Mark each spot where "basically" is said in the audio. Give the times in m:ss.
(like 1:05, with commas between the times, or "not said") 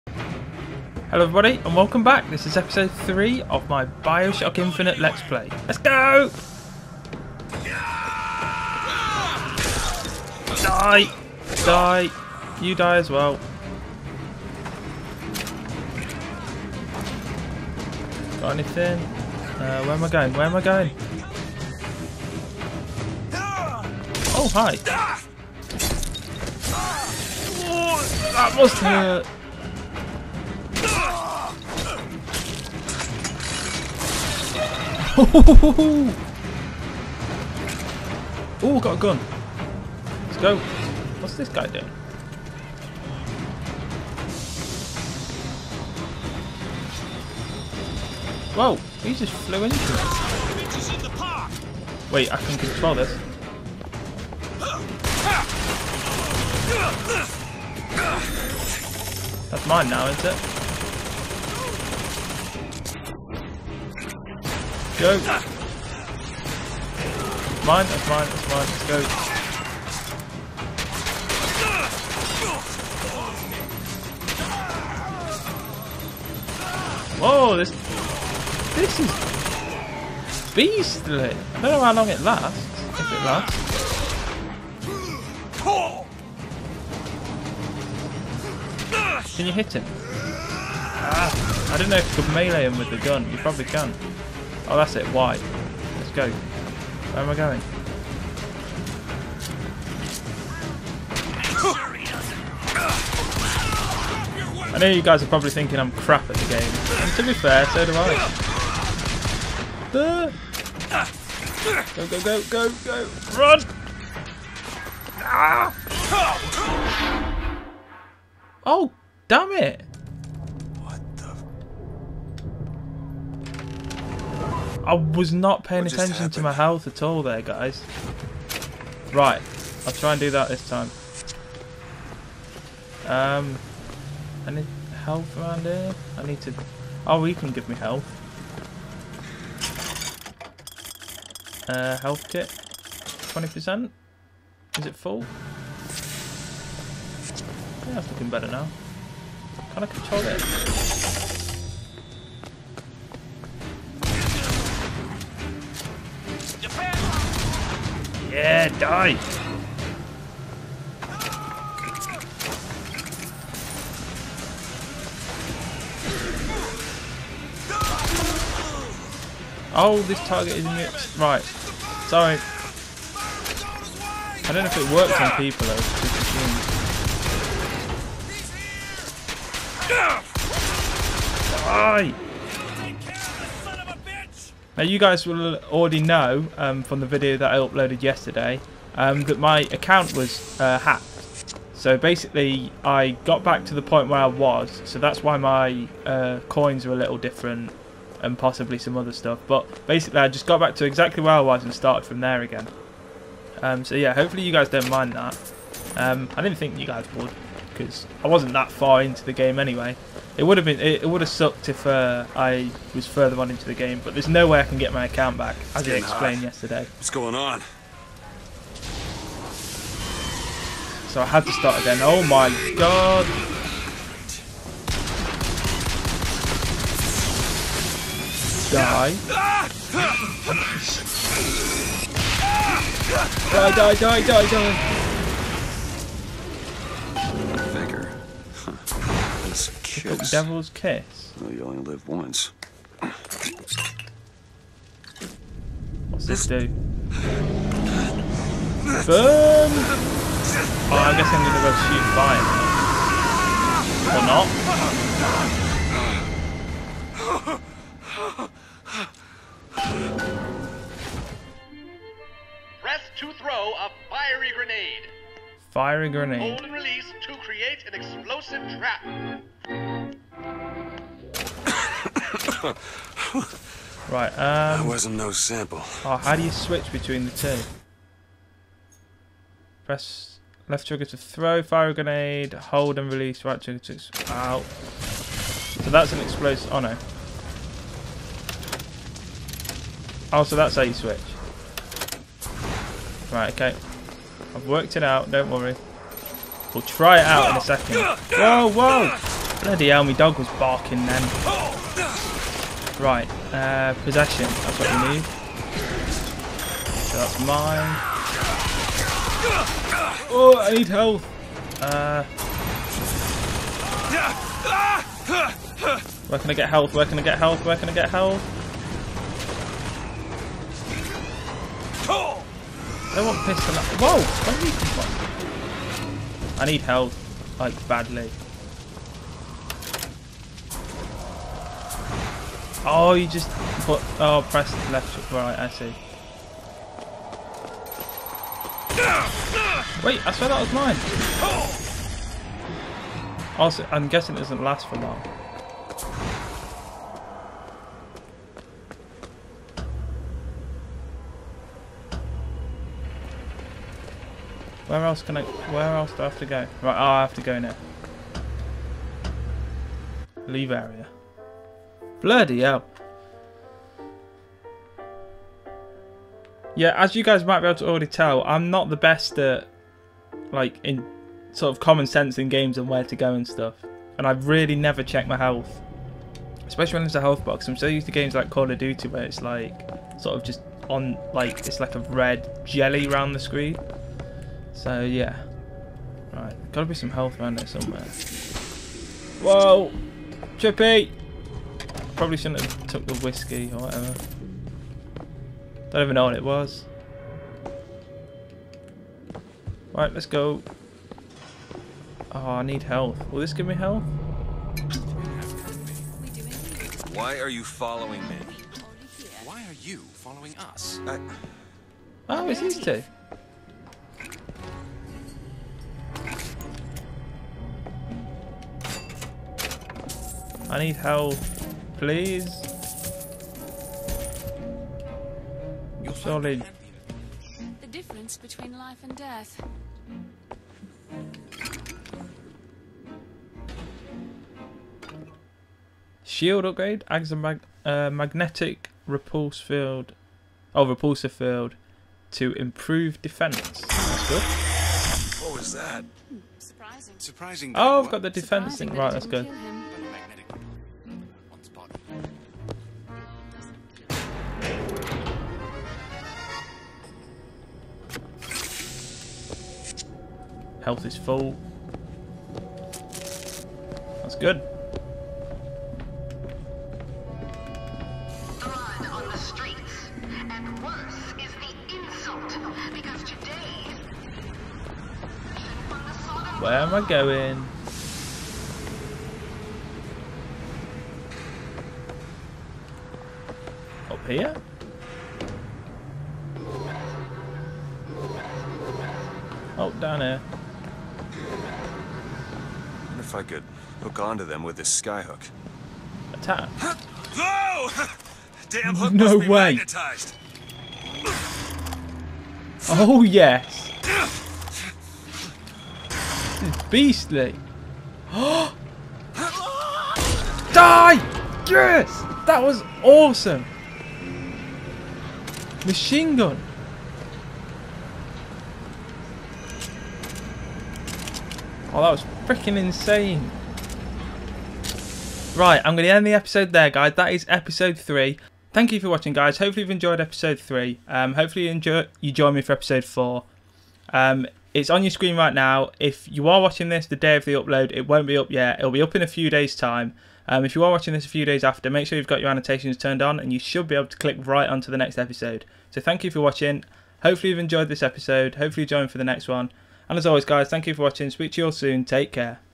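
3:11, 3:19.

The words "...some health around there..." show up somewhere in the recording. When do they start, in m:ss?
6:26.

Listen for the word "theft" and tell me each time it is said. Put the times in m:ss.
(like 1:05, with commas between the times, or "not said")
not said.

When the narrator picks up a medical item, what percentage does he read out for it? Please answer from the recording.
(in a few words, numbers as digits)
20%.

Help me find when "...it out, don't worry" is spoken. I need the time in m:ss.
4:54.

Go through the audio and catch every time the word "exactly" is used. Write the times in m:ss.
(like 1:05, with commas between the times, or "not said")
3:20.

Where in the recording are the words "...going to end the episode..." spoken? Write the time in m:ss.
8:45.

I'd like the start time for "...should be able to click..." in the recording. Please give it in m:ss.
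9:03.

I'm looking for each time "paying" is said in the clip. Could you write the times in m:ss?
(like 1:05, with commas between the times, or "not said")
2:05.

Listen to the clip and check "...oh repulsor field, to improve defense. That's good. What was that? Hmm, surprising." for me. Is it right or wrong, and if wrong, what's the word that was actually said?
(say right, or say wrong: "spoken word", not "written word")
right.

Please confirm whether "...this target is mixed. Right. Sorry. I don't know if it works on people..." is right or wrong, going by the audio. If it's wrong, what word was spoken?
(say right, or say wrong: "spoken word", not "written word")
right.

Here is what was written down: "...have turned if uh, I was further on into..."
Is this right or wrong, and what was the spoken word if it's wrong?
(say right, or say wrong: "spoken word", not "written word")
wrong: "sucked", not "turned".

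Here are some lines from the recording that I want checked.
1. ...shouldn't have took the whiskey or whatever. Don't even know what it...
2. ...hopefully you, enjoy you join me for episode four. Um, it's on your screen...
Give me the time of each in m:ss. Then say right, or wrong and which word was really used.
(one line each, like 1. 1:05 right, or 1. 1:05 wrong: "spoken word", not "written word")
1. 6:32 right
2. 8:51 right.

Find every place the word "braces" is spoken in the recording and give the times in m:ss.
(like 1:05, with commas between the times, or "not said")
not said.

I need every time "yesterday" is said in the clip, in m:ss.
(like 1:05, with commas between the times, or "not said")
3:08, 3:36.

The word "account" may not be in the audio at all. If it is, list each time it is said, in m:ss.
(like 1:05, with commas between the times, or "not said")
3:09, 3:35.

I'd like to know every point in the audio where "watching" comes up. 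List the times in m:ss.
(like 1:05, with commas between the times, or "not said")
8:49, 8:56, 9:00, 9:06, 9:11.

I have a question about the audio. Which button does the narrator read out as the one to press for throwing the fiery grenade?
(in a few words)
Left trigger.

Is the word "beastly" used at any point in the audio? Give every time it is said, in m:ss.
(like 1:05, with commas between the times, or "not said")
1:20, 8:26.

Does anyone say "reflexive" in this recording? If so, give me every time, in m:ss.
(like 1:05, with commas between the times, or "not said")
not said.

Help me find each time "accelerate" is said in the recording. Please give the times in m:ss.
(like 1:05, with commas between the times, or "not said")
not said.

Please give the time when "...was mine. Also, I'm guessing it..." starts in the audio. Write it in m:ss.
5:40.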